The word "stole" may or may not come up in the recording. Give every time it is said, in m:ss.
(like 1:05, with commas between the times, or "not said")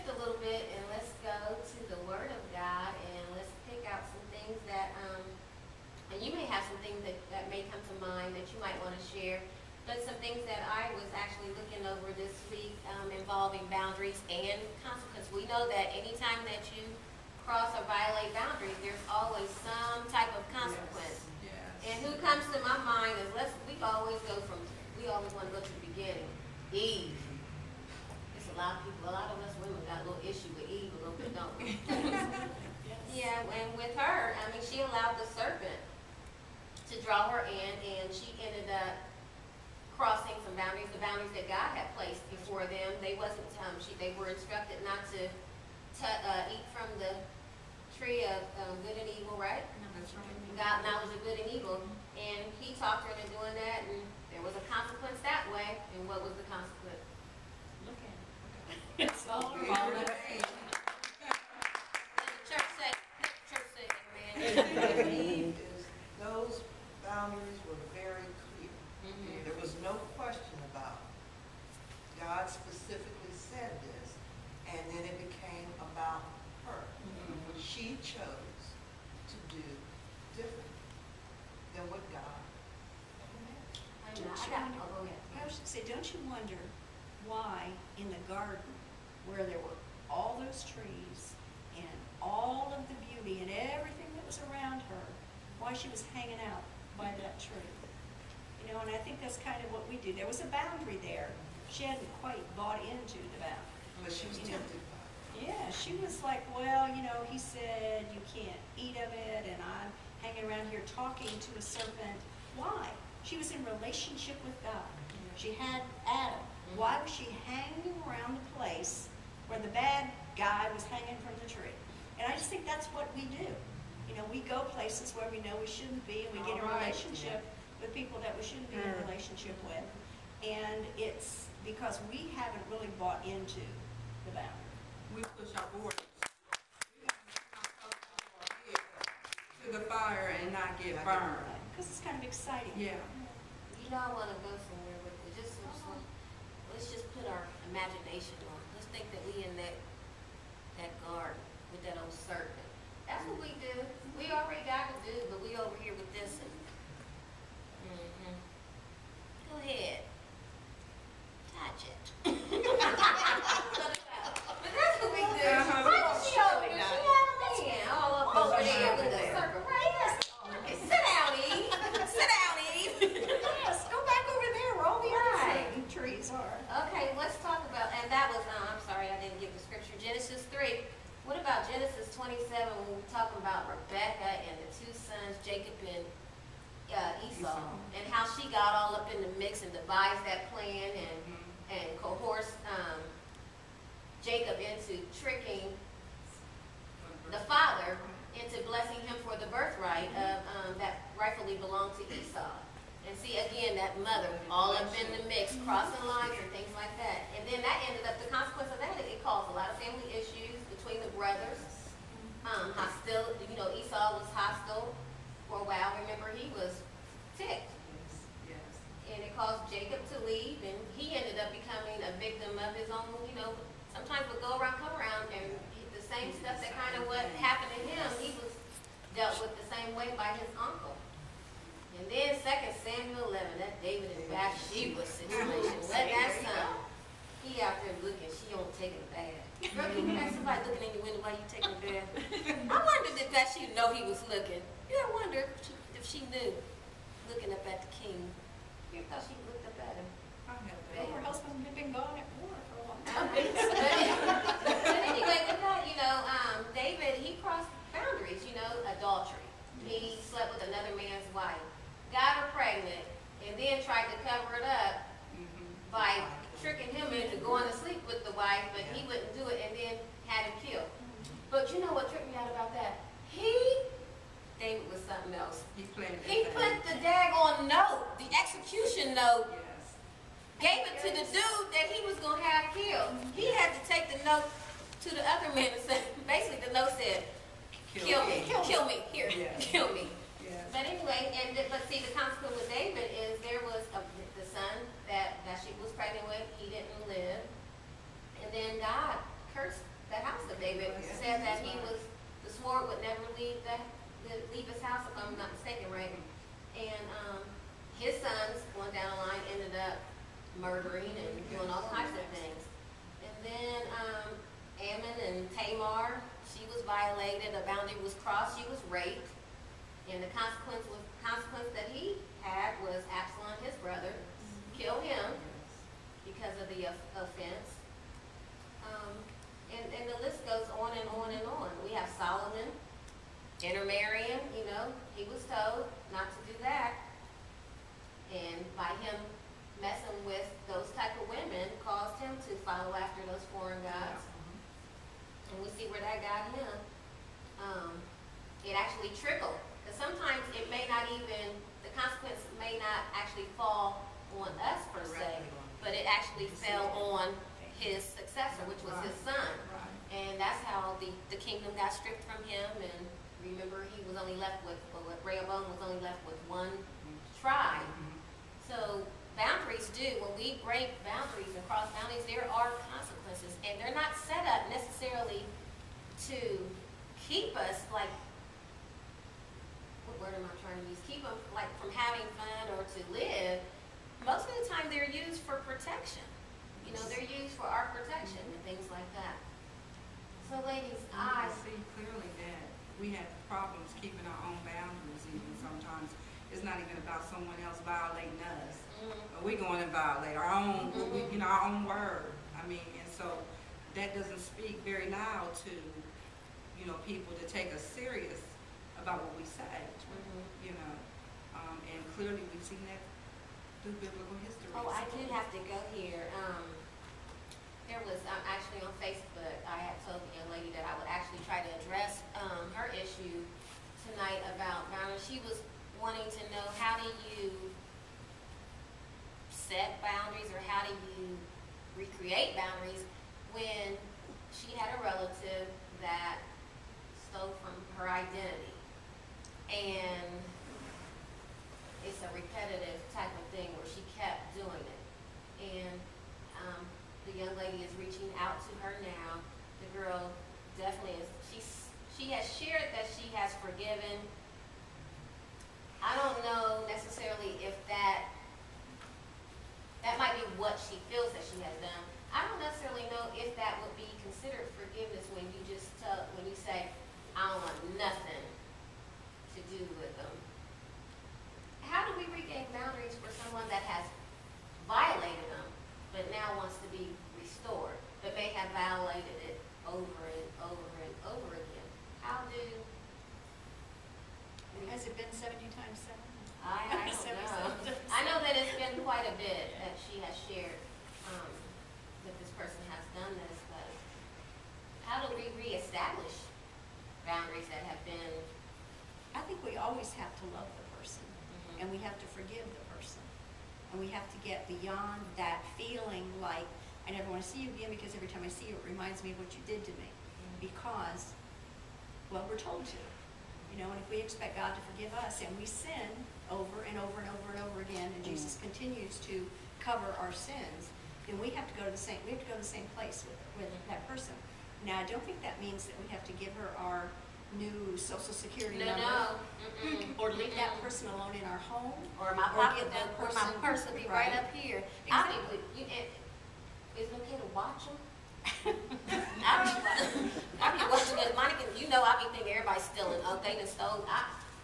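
7:17, 9:03.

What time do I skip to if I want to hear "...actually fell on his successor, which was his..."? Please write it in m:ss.
5:56.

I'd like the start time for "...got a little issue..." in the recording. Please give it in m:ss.
0:29.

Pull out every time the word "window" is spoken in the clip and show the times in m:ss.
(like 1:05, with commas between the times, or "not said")
4:01.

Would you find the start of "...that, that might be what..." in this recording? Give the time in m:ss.
7:37.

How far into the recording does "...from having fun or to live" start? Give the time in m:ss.
6:21.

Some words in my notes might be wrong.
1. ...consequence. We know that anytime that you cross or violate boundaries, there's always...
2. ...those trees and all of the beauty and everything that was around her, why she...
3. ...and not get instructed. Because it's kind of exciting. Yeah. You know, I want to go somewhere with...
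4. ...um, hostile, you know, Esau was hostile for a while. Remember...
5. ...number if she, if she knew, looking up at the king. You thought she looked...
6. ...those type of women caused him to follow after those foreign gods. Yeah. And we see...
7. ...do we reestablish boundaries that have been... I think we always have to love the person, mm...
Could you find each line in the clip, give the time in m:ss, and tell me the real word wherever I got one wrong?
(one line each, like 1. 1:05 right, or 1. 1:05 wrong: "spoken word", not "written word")
1. 0:14 right
2. 1:30 right
3. 2:20 wrong: "burned", not "instructed"
4. 3:32 right
5. 4:05 wrong: "wonder", not "number"
6. 5:40 right
7. 8:15 right.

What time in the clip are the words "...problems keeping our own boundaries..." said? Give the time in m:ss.
6:33.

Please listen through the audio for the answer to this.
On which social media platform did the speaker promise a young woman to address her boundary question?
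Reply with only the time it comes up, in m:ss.
6:58.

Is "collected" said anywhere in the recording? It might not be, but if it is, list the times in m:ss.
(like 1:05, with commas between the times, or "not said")
not said.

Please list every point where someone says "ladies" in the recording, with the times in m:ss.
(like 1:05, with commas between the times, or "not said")
6:30.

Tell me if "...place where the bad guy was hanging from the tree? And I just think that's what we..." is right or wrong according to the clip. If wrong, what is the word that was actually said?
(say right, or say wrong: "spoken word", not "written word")
right.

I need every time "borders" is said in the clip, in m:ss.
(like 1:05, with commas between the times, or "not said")
2:15.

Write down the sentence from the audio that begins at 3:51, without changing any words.
And then 2 Samuel 11, that David and Bathsheba situation.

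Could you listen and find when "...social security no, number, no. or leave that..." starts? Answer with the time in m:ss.
8:47.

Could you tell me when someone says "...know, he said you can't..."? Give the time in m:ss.
1:47.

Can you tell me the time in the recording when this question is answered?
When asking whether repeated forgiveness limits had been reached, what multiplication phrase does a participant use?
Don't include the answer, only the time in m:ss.
8:05.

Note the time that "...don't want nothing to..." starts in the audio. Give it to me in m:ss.
7:47.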